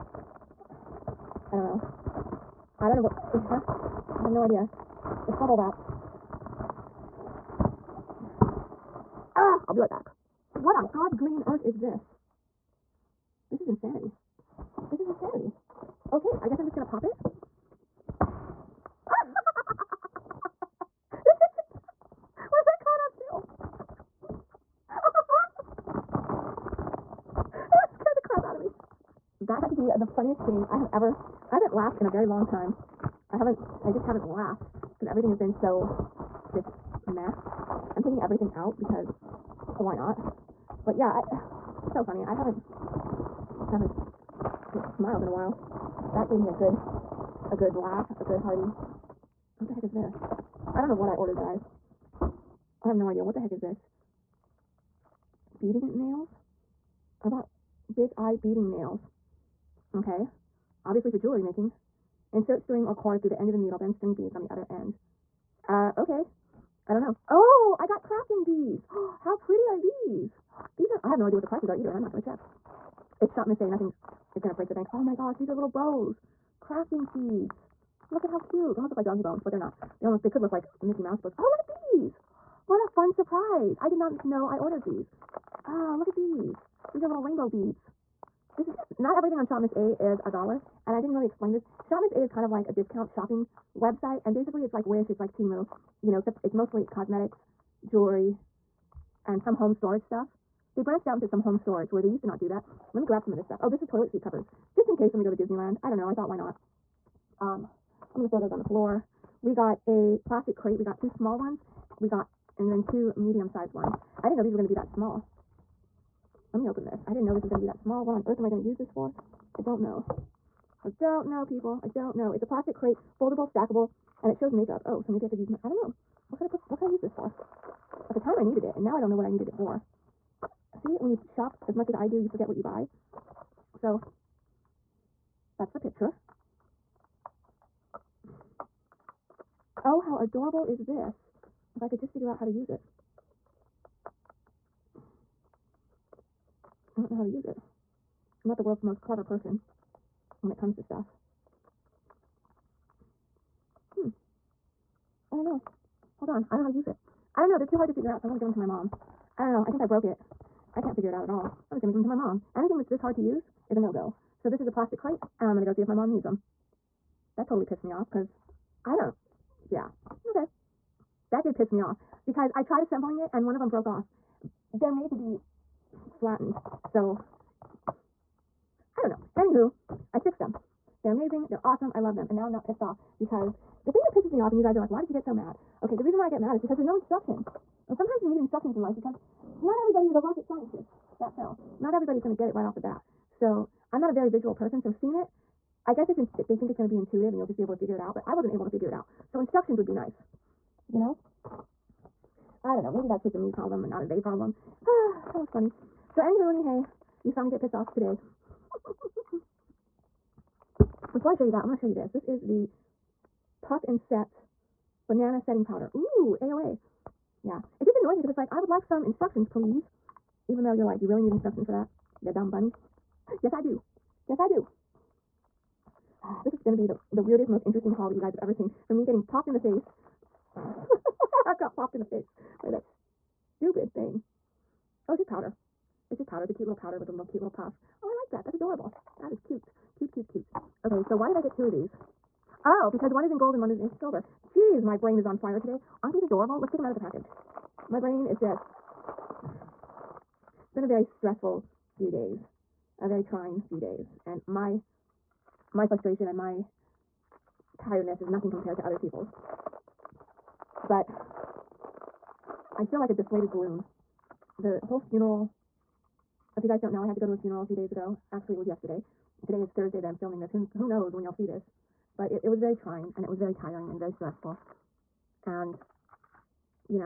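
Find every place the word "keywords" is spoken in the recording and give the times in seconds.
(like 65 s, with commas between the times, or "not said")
not said.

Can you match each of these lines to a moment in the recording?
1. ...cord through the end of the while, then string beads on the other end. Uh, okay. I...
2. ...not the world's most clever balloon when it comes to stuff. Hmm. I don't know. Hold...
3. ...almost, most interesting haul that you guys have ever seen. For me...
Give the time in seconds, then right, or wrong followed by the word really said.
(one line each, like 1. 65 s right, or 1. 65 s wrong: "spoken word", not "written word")
1. 62 s wrong: "needle", not "while"
2. 148 s wrong: "person", not "balloon"
3. 227 s wrong: "weirdest", not "almost".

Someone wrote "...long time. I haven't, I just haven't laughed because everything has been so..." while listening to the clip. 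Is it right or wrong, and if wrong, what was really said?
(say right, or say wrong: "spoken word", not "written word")
right.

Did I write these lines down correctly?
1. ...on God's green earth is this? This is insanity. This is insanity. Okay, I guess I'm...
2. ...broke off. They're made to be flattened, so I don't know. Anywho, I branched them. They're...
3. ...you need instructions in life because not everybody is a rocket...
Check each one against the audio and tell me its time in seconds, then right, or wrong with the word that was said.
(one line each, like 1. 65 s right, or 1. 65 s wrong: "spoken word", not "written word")
1. 10 s right
2. 173 s wrong: "fixed", not "branched"
3. 188 s right.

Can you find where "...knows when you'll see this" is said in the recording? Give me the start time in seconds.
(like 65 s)
270 s.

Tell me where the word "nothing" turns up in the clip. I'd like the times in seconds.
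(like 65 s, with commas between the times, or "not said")
73 s, 258 s.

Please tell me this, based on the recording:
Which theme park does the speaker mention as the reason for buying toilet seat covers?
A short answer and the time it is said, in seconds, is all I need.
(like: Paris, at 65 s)
Disneyland, at 105 s.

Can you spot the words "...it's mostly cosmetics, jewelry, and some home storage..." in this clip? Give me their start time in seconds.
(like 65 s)
96 s.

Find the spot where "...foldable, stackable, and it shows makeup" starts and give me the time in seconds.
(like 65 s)
123 s.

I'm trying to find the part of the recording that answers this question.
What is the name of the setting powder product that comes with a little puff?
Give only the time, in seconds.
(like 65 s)
213 s.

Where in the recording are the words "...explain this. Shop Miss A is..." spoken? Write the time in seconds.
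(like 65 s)
91 s.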